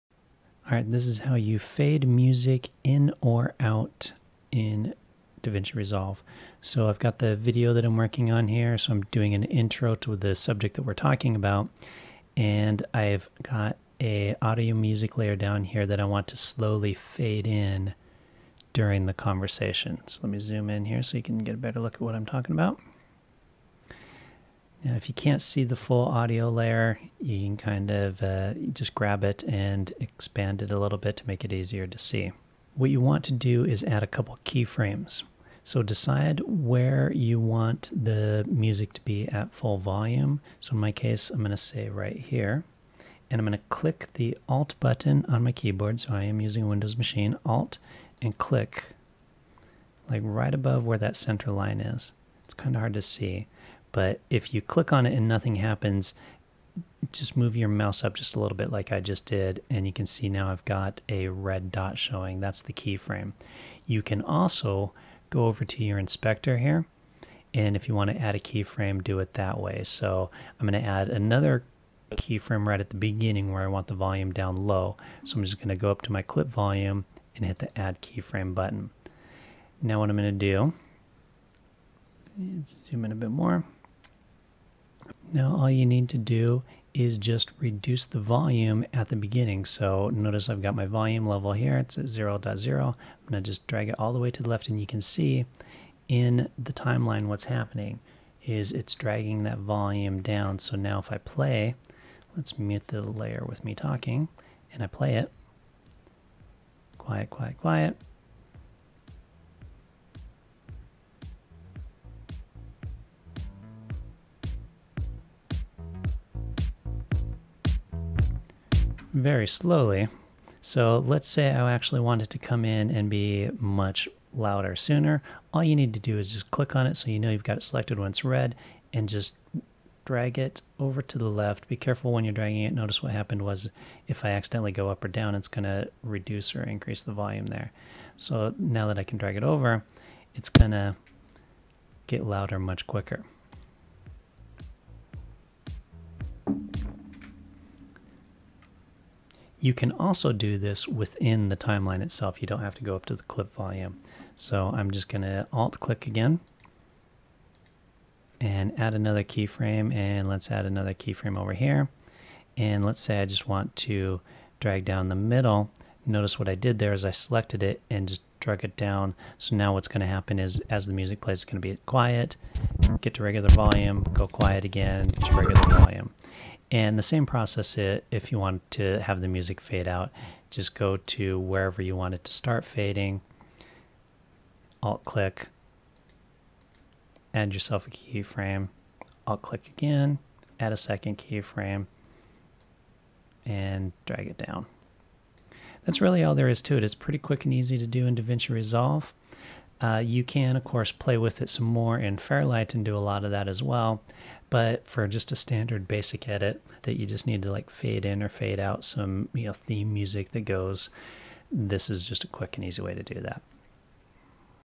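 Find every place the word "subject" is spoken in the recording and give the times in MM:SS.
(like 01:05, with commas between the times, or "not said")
00:10.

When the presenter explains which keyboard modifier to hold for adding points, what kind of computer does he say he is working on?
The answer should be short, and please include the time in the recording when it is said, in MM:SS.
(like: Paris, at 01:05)
Windows, at 00:46.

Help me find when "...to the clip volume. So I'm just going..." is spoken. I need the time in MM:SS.
02:33.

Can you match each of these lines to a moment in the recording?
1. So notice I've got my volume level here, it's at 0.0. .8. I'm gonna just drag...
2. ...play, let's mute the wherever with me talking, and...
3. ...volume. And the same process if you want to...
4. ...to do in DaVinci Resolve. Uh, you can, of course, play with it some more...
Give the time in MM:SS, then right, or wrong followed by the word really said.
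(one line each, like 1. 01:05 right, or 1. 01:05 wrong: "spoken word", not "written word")
1. 01:29 wrong: "0", not "8"
2. 01:41 wrong: "layer", not "wherever"
3. 02:55 right
4. 03:17 right.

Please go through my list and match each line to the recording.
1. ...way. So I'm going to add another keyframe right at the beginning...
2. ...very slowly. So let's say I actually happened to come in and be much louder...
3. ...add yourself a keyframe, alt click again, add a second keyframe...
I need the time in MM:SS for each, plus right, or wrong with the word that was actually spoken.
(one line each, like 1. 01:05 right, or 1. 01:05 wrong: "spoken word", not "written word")
1. 01:09 right
2. 01:59 wrong: "wanted", not "happened"
3. 03:07 right.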